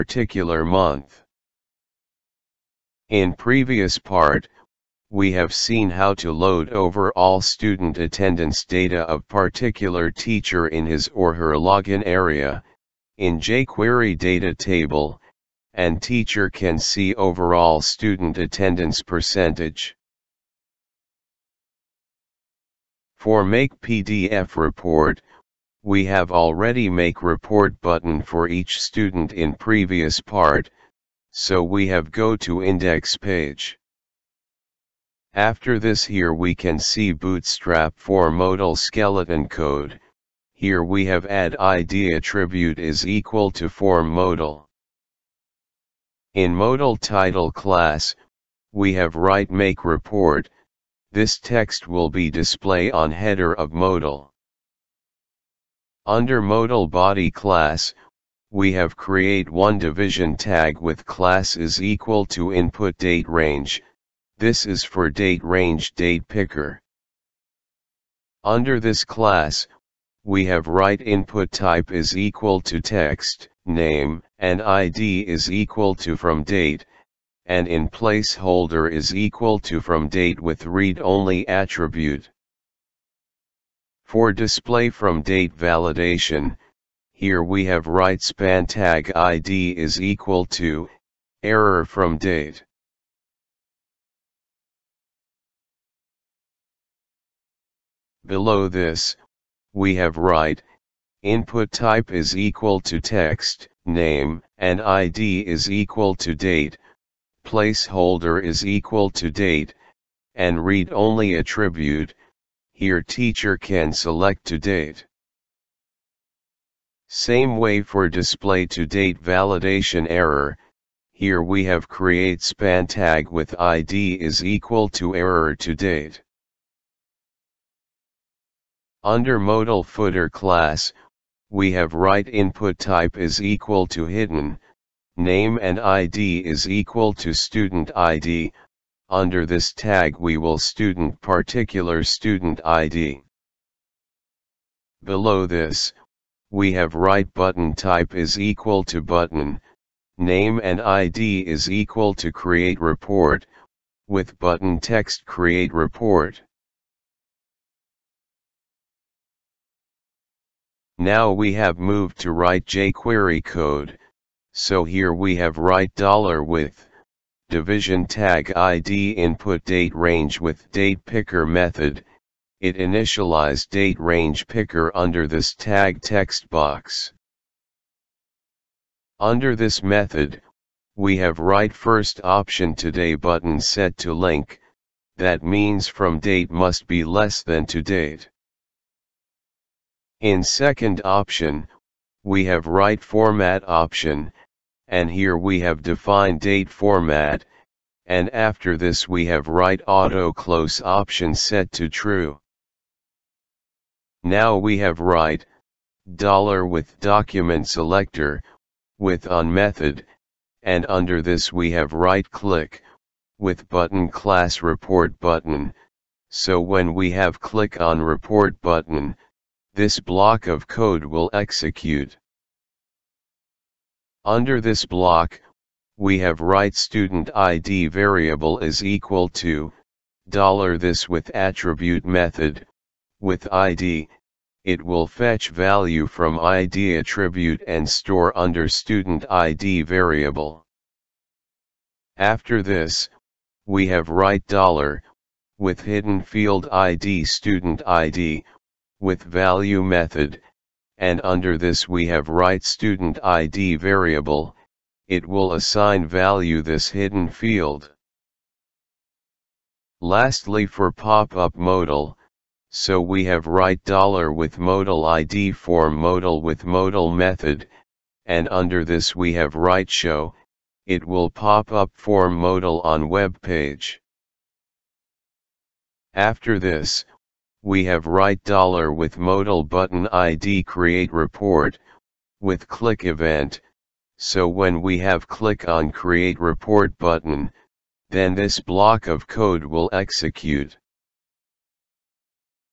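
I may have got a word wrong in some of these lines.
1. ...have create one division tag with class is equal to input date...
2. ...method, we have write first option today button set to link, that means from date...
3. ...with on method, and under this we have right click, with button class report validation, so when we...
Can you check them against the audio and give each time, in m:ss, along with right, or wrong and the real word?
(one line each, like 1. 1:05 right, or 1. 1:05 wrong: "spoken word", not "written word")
1. 0:58 right
2. 2:59 right
3. 3:28 wrong: "button", not "validation".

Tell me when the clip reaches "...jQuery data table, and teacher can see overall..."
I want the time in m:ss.
0:13.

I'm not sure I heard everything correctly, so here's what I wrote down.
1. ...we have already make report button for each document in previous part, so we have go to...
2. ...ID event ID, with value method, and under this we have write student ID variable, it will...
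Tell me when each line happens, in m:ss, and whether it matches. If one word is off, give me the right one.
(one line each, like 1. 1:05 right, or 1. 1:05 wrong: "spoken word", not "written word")
1. 0:25 wrong: "student", not "document"
2. 4:06 wrong: "student", not "event".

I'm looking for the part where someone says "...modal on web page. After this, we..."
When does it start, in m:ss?
4:32.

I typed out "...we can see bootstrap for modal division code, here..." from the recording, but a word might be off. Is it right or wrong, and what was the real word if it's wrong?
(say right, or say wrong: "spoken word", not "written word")
wrong: "skeleton", not "division".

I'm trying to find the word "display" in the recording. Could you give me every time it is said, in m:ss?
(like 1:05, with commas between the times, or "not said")
0:52, 1:24, 1:58.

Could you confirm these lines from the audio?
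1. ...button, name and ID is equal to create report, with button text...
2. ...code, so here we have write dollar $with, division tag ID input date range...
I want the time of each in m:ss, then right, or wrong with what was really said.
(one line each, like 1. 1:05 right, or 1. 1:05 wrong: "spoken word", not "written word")
1. 2:29 right
2. 2:43 right.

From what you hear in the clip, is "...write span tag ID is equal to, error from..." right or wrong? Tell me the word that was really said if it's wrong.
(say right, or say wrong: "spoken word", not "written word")
right.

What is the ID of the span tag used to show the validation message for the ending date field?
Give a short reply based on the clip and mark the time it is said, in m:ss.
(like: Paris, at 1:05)
error to date, at 2:05.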